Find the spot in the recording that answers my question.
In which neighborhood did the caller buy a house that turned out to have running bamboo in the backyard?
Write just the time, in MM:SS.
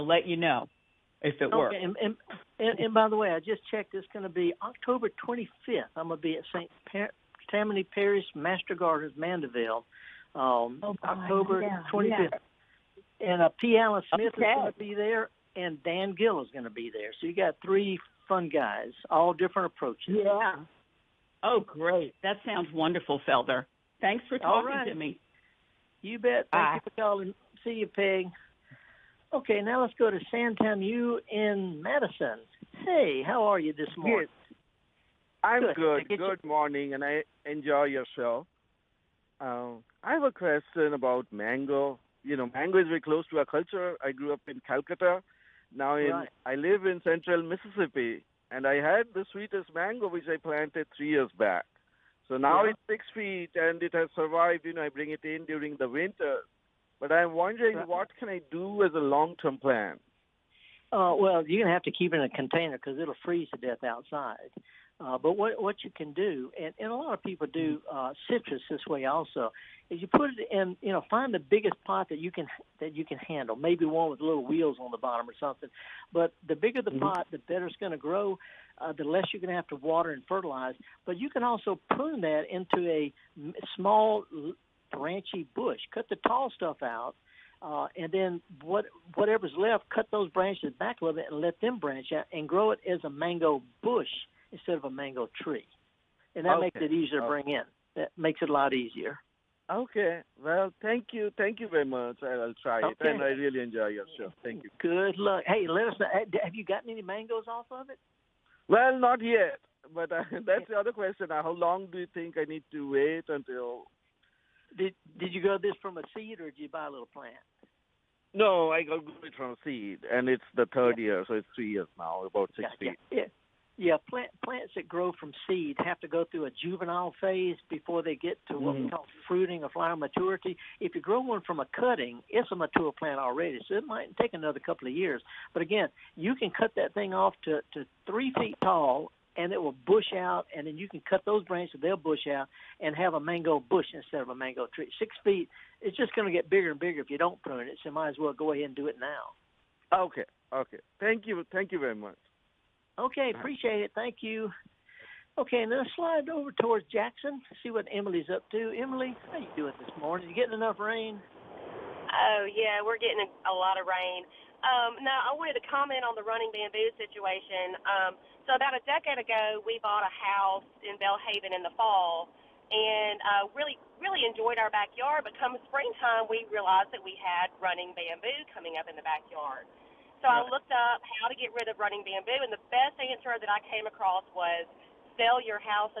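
02:51.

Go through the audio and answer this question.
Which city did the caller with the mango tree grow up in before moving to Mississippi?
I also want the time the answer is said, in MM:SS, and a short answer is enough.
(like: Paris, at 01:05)
Calcutta, at 00:44.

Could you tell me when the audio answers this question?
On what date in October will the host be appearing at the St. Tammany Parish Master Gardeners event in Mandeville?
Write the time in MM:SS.
00:04.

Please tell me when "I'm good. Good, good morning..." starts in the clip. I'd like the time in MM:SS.
00:35.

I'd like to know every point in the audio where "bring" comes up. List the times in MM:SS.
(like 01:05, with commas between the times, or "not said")
00:54, 01:37.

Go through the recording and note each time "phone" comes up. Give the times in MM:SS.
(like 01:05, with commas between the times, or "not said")
not said.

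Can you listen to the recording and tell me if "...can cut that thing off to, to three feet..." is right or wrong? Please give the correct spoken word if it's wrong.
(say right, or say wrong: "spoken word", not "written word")
right.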